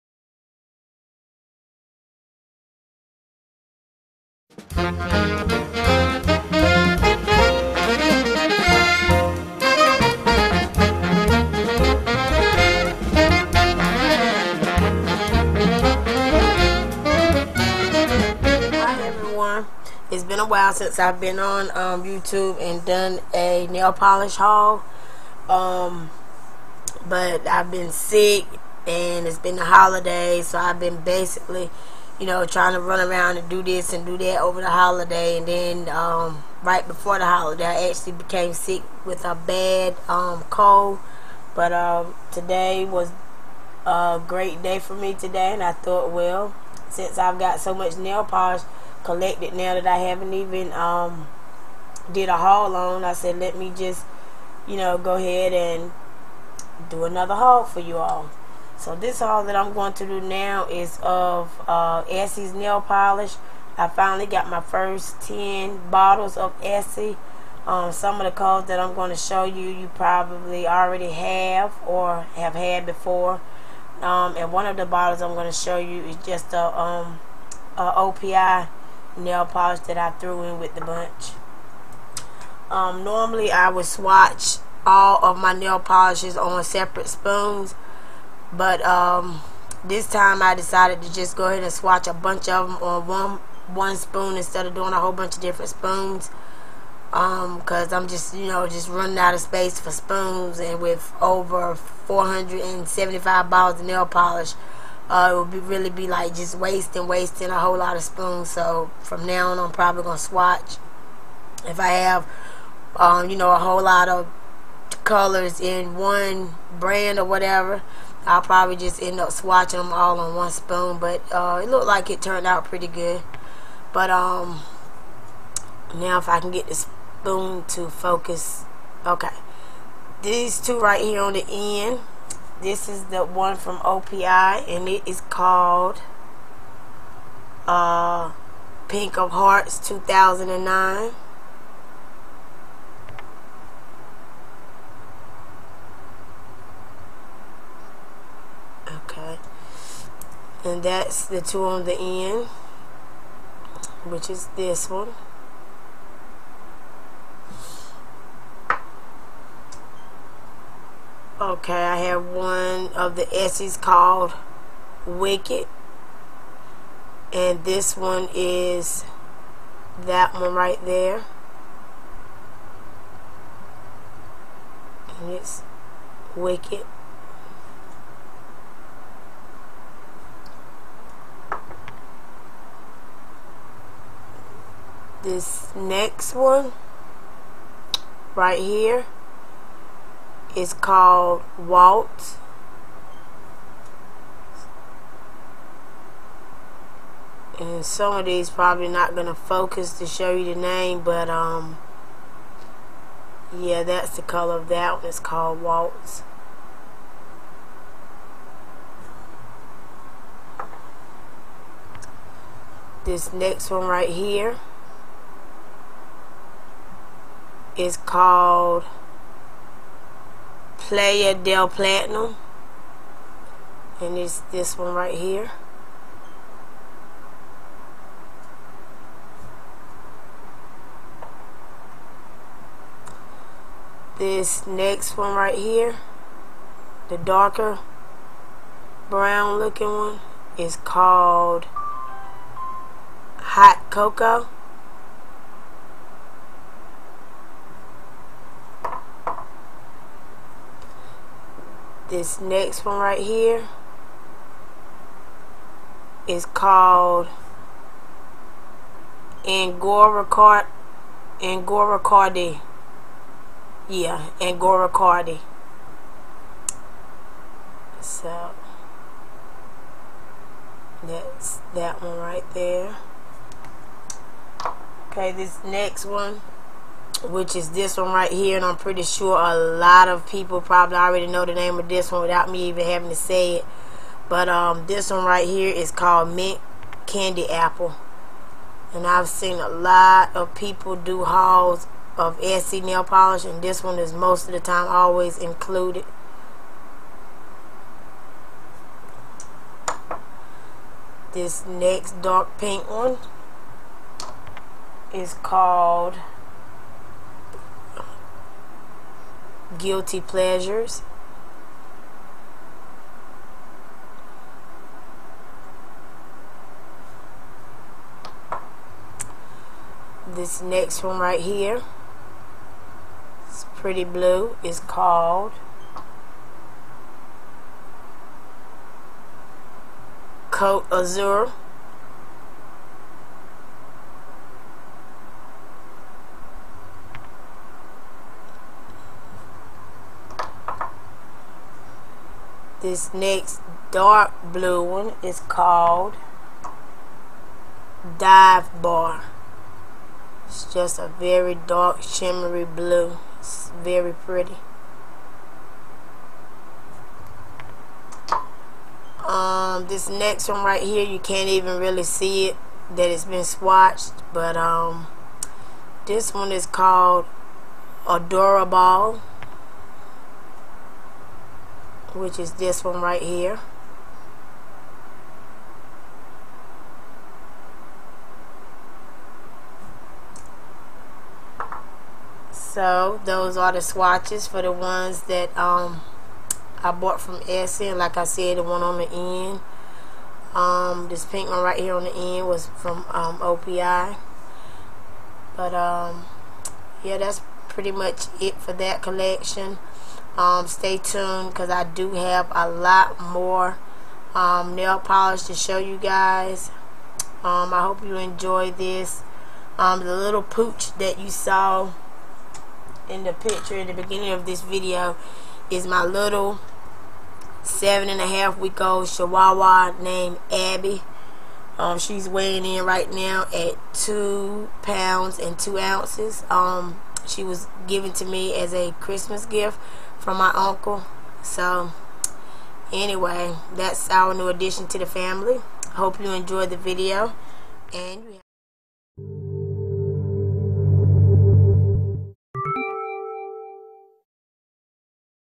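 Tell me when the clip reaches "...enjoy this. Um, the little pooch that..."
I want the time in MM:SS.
06:48.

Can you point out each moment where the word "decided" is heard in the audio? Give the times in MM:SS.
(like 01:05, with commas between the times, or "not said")
01:30.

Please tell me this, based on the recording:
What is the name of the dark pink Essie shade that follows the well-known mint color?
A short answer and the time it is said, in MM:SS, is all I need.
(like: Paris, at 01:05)
Guilty Pleasures, at 05:09.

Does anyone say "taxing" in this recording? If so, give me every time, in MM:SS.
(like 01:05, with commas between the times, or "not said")
not said.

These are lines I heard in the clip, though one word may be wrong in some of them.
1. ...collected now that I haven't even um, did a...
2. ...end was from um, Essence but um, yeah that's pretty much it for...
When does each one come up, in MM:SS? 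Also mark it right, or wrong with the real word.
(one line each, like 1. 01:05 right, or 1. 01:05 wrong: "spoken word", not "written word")
1. 00:49 right
2. 06:32 wrong: "OPI", not "Essence".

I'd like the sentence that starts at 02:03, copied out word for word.
But um, now if I can get the spoon to focus, okay.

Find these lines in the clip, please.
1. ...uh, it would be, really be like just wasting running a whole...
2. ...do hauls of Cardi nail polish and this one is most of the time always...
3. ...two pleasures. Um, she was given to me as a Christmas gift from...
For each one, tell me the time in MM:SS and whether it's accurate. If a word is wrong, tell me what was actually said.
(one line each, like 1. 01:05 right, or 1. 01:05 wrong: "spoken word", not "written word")
1. 01:45 wrong: "wasting", not "running"
2. 04:50 wrong: "Essie", not "Cardi"
3. 07:05 wrong: "ounces", not "pleasures".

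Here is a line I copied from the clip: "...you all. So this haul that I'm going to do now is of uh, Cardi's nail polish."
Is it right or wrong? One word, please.
wrong.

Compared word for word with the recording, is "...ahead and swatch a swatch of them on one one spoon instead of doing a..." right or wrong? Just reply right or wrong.
wrong.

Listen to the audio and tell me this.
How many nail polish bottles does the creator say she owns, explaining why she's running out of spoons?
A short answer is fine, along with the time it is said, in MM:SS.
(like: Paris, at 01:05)
over 475, at 01:41.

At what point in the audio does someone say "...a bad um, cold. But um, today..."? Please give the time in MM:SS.
00:39.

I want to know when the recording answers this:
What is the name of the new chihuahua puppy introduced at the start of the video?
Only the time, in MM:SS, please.
07:00.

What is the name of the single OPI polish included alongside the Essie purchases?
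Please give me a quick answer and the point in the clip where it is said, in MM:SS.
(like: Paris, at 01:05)
Pink of Hearts 2009, at 02:18.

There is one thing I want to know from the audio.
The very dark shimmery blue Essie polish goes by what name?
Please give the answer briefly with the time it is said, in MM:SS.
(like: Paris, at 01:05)
Dive Bar, at 05:48.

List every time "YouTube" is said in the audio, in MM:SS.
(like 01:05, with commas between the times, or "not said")
00:22.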